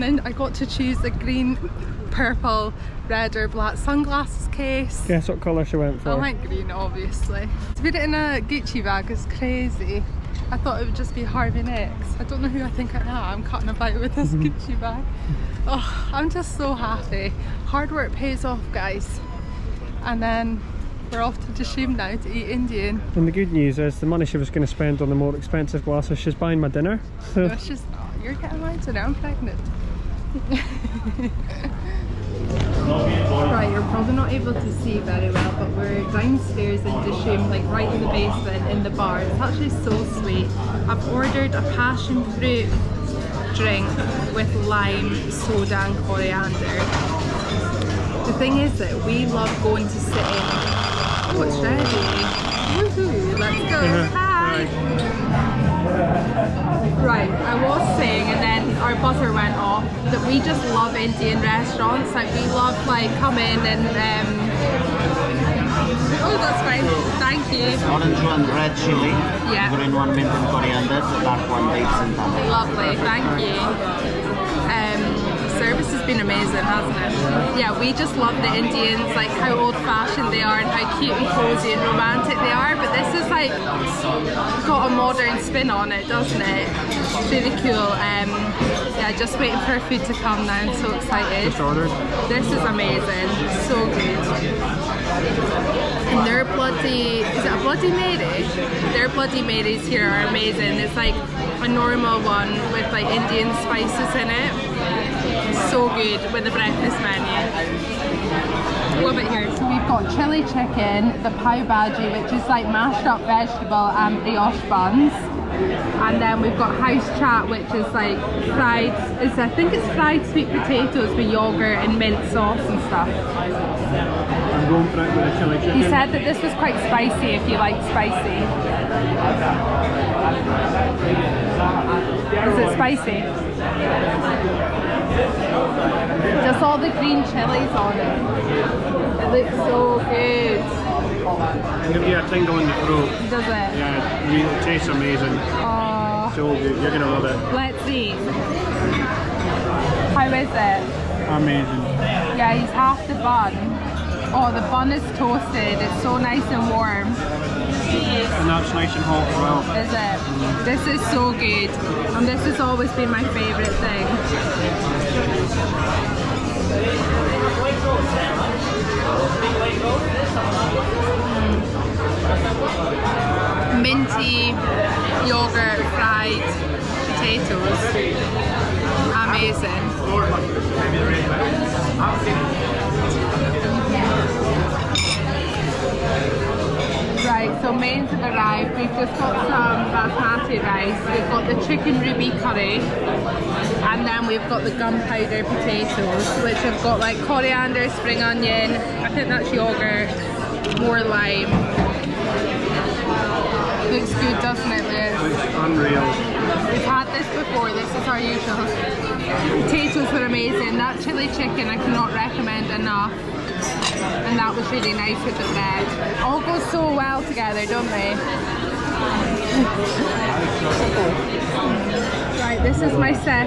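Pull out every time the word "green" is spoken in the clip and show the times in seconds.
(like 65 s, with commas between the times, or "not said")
1 s, 6 s, 69 s, 136 s.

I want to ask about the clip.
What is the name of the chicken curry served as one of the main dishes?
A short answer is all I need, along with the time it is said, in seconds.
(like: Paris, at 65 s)
Chicken ruby, at 191 s.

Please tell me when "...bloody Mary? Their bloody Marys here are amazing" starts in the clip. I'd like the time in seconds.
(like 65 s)
97 s.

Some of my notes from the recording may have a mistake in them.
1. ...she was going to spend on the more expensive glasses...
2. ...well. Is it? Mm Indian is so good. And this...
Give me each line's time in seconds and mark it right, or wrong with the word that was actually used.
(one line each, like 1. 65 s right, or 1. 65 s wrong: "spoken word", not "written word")
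1. 24 s right
2. 159 s wrong: "This", not "Indian".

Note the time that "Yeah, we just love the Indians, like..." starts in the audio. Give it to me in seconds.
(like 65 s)
77 s.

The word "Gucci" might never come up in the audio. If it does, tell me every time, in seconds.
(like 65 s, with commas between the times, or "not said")
8 s, 14 s.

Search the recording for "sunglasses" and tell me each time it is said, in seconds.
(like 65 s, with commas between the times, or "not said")
3 s.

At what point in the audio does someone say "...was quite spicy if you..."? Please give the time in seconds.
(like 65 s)
126 s.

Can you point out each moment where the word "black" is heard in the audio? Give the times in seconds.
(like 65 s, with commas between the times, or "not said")
3 s.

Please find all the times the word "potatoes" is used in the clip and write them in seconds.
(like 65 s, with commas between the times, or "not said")
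120 s, 177 s, 195 s, 209 s.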